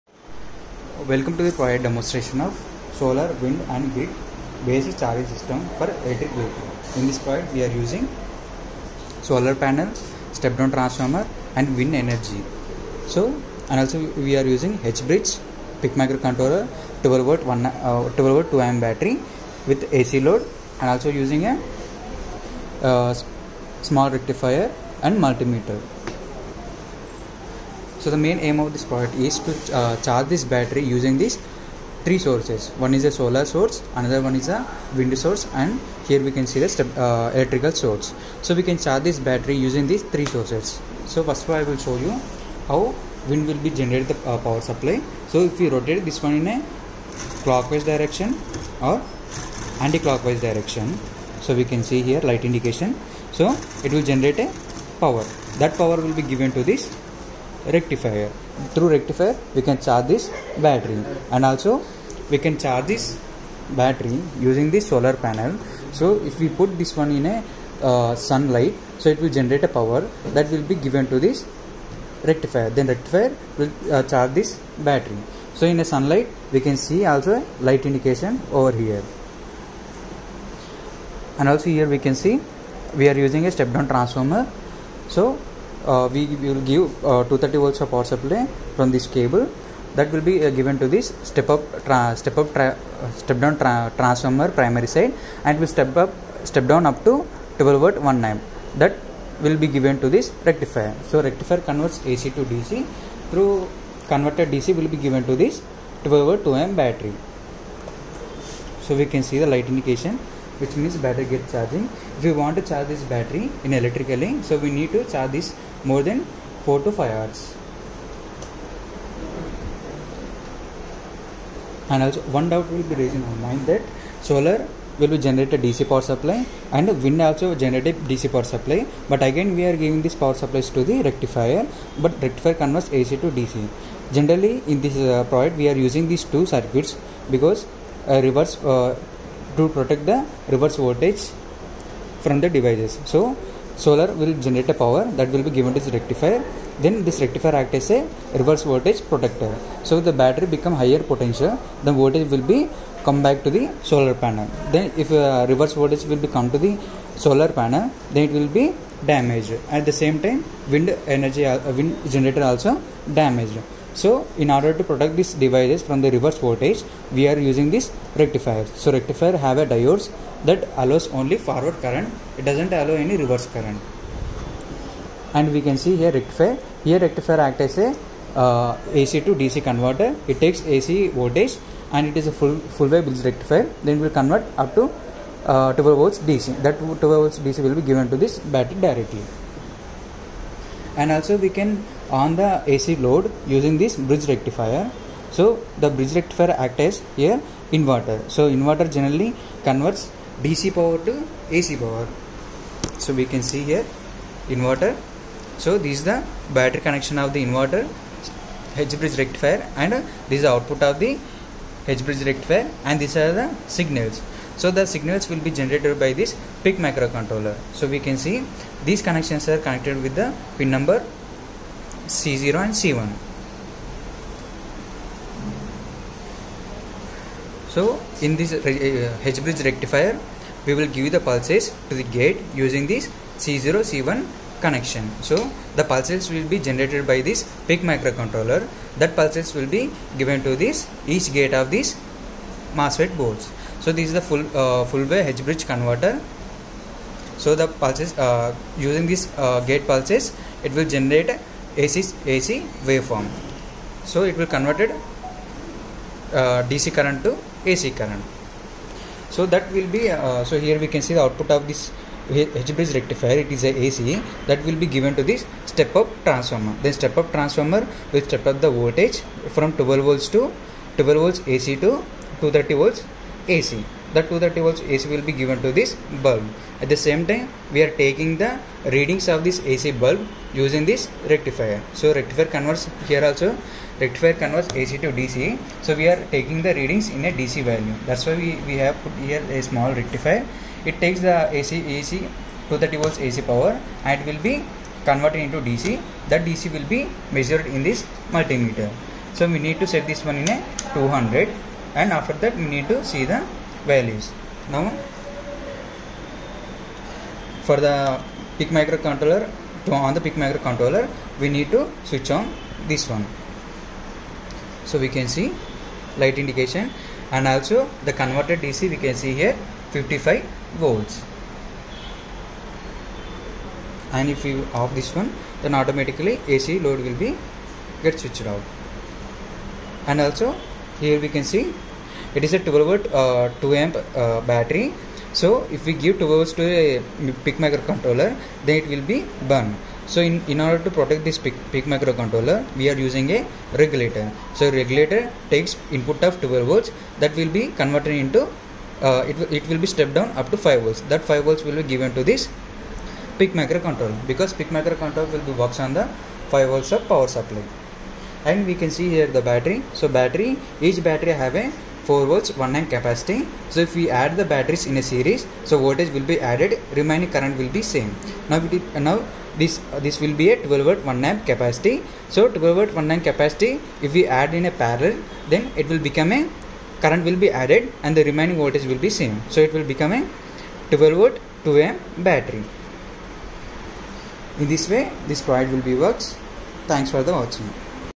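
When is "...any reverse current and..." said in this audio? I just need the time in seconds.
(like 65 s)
172 s.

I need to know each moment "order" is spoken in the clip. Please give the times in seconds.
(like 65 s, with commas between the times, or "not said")
164 s, 340 s.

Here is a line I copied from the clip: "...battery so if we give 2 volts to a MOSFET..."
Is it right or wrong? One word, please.
wrong.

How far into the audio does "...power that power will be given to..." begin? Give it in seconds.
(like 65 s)
55 s.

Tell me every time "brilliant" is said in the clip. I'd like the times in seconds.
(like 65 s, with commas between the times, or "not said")
not said.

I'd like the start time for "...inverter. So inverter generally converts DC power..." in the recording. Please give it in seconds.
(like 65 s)
197 s.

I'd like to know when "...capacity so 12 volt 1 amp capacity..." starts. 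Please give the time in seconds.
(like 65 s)
371 s.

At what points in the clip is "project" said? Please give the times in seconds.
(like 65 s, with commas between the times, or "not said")
1 s, 7 s, 135 s.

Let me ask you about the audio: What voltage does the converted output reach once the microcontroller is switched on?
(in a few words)
55 volts.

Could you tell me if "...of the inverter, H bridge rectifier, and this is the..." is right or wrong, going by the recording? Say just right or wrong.
right.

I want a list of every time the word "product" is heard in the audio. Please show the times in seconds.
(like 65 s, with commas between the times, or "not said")
28 s, 385 s.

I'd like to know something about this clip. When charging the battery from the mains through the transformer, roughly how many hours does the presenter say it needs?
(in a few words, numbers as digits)
4 to 5 hours.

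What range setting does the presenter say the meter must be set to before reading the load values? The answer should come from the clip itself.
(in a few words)
200.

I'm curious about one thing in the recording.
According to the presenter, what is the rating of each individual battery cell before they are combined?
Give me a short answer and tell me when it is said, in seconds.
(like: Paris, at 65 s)
4 volts 1 amp, at 362 s.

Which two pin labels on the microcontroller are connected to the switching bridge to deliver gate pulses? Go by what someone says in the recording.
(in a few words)
C0 and C1.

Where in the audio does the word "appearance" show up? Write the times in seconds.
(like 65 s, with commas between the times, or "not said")
not said.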